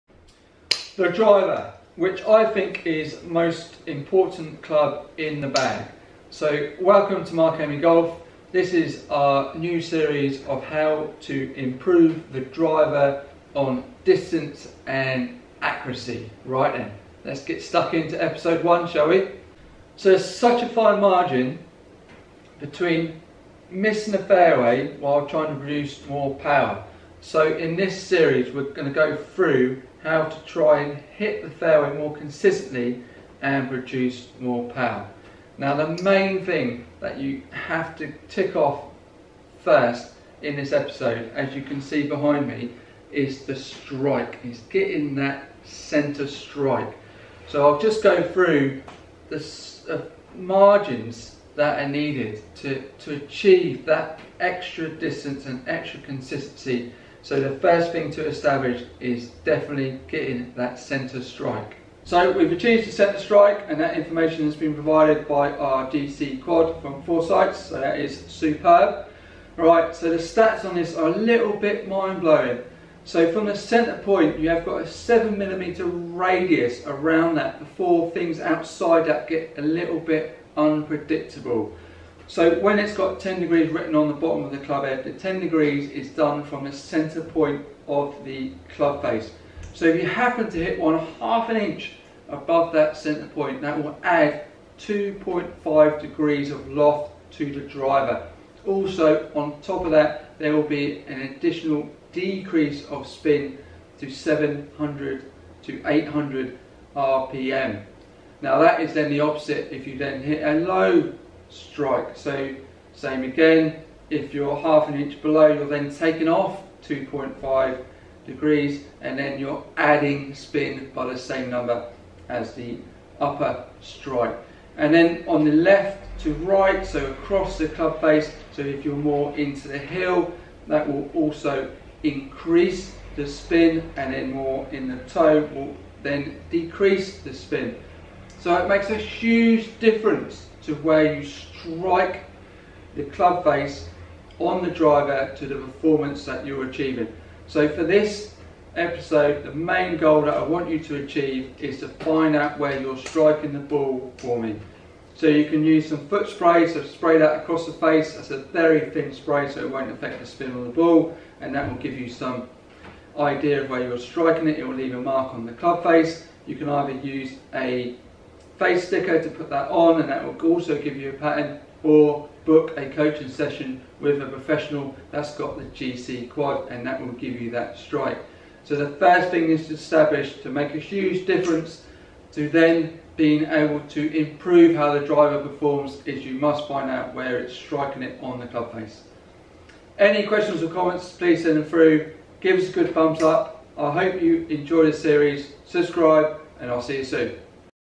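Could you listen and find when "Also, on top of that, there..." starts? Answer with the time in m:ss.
1:38.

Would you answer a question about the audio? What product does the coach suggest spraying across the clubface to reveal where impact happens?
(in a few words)
Foot spray.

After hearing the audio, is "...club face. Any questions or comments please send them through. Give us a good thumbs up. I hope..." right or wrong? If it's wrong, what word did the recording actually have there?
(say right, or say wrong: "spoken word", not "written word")
right.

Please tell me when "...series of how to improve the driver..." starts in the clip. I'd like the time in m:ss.
0:09.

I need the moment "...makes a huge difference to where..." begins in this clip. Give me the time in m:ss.
2:18.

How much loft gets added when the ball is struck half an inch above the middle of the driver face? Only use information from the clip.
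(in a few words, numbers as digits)
2.5 degrees.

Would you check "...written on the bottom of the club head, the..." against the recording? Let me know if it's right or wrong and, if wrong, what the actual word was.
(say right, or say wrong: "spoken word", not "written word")
right.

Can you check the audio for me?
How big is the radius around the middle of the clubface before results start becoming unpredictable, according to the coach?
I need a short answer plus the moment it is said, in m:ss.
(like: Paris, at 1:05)
7mm, at 1:14.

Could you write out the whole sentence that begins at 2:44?
It will leave a mark on the club face.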